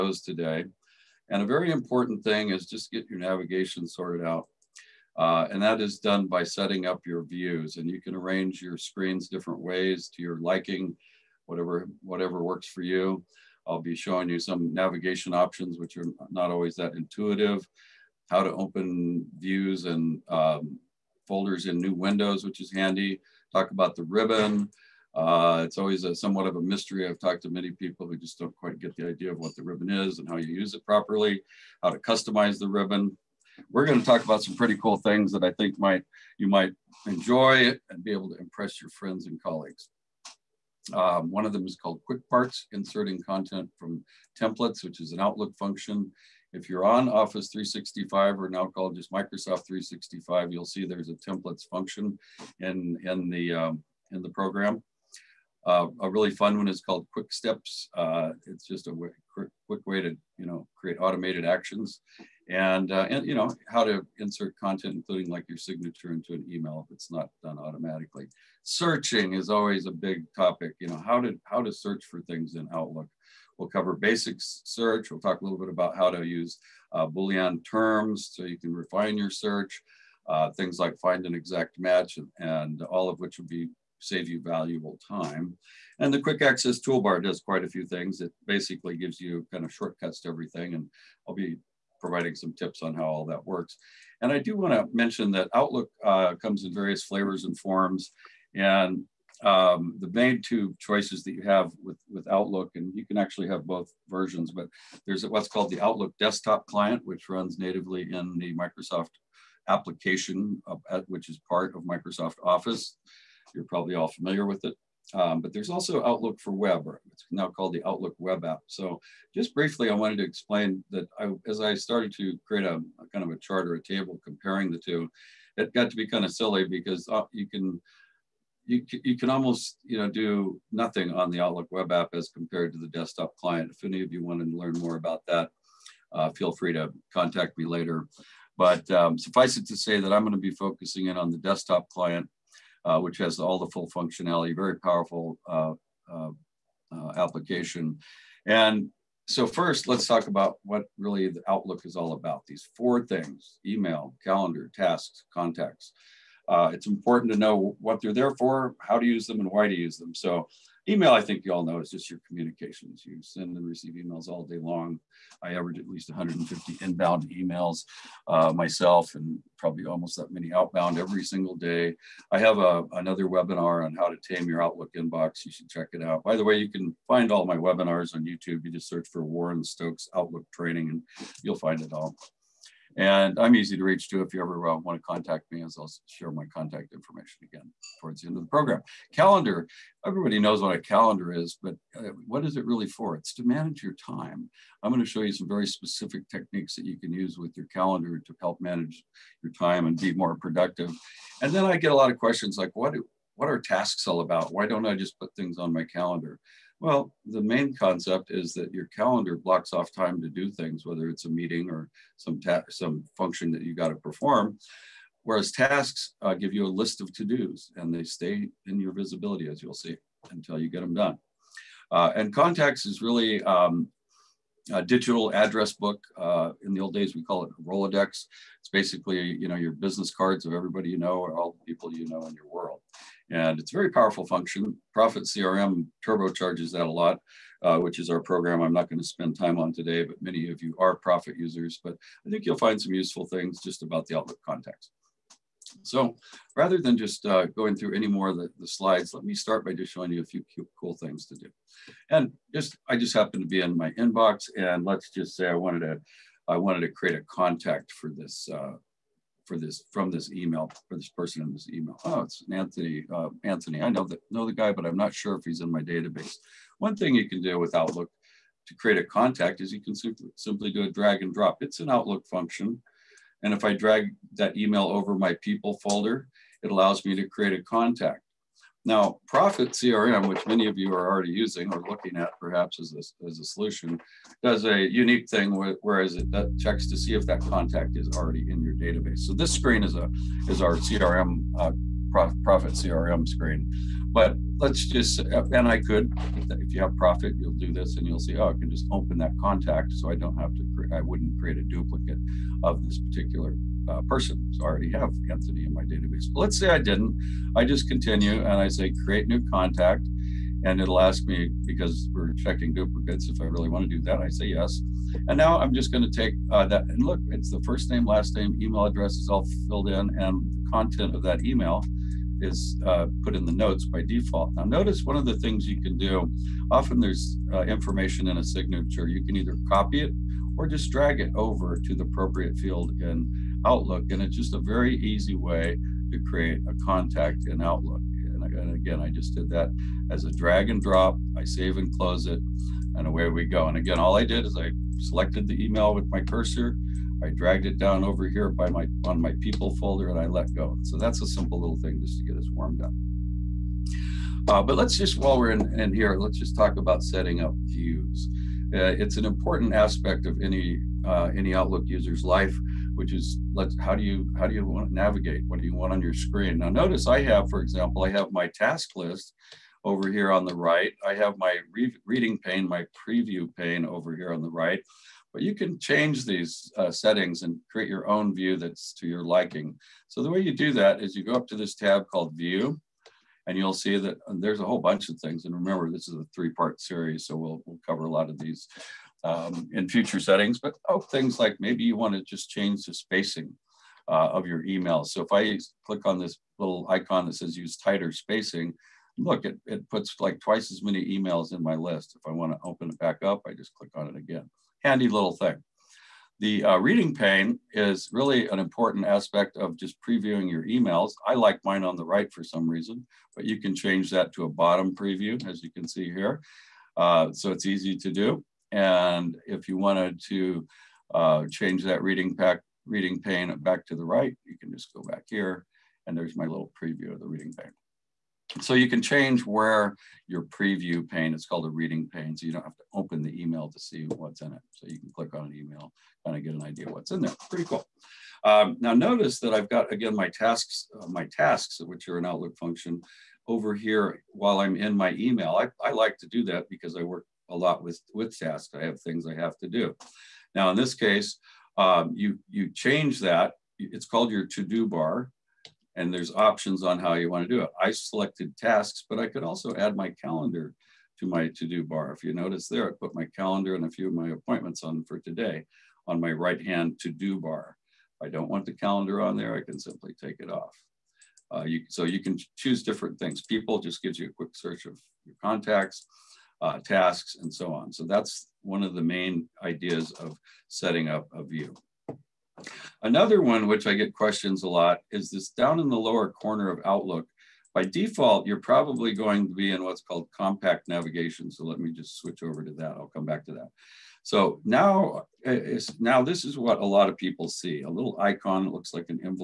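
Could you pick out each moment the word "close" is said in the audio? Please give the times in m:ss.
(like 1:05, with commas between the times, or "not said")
5:41.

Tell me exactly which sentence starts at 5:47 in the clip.
I dragged it down over here by my on my people folder and I let go.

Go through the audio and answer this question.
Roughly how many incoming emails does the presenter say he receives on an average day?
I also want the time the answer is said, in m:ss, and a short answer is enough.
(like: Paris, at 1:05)
150, at 2:46.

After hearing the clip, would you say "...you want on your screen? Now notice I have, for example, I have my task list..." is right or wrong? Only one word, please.
right.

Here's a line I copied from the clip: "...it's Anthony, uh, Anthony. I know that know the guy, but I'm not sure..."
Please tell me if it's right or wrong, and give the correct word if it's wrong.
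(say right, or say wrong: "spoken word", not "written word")
right.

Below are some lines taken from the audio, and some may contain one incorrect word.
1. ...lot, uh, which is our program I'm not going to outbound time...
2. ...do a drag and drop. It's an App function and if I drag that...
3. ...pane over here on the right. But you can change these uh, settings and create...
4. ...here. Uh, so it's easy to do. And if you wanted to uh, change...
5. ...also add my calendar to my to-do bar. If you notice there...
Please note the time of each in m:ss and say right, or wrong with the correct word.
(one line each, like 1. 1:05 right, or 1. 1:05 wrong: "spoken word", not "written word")
1. 3:56 wrong: "spend", not "outbound"
2. 4:30 wrong: "Outlook", not "App"
3. 6:13 right
4. 6:56 right
5. 7:39 right.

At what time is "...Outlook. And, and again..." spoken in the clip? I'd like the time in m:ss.
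5:37.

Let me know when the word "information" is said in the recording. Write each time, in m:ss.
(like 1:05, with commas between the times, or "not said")
3:06, 5:27.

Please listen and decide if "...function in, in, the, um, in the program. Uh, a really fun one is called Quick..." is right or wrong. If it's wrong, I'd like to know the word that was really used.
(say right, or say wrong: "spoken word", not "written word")
right.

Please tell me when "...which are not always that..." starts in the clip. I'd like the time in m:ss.
0:15.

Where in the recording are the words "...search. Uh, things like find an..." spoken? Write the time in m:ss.
1:19.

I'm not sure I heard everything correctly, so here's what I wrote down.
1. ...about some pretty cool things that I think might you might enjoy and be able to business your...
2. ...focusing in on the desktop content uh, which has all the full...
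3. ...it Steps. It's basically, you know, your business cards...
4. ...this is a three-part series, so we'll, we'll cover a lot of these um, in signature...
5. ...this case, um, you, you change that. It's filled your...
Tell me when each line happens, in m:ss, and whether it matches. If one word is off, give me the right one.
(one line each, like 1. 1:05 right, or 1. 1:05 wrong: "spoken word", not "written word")
1. 0:34 wrong: "impress", not "business"
2. 2:20 wrong: "client", not "content"
3. 3:47 wrong: "Rolodex", not "Steps"
4. 6:25 wrong: "future", not "signature"
5. 7:30 wrong: "called", not "filled".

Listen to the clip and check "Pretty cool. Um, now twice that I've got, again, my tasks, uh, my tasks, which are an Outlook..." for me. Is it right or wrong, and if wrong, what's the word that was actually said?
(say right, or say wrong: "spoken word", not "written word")
wrong: "notice", not "twice".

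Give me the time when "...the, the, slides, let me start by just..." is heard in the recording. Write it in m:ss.
4:08.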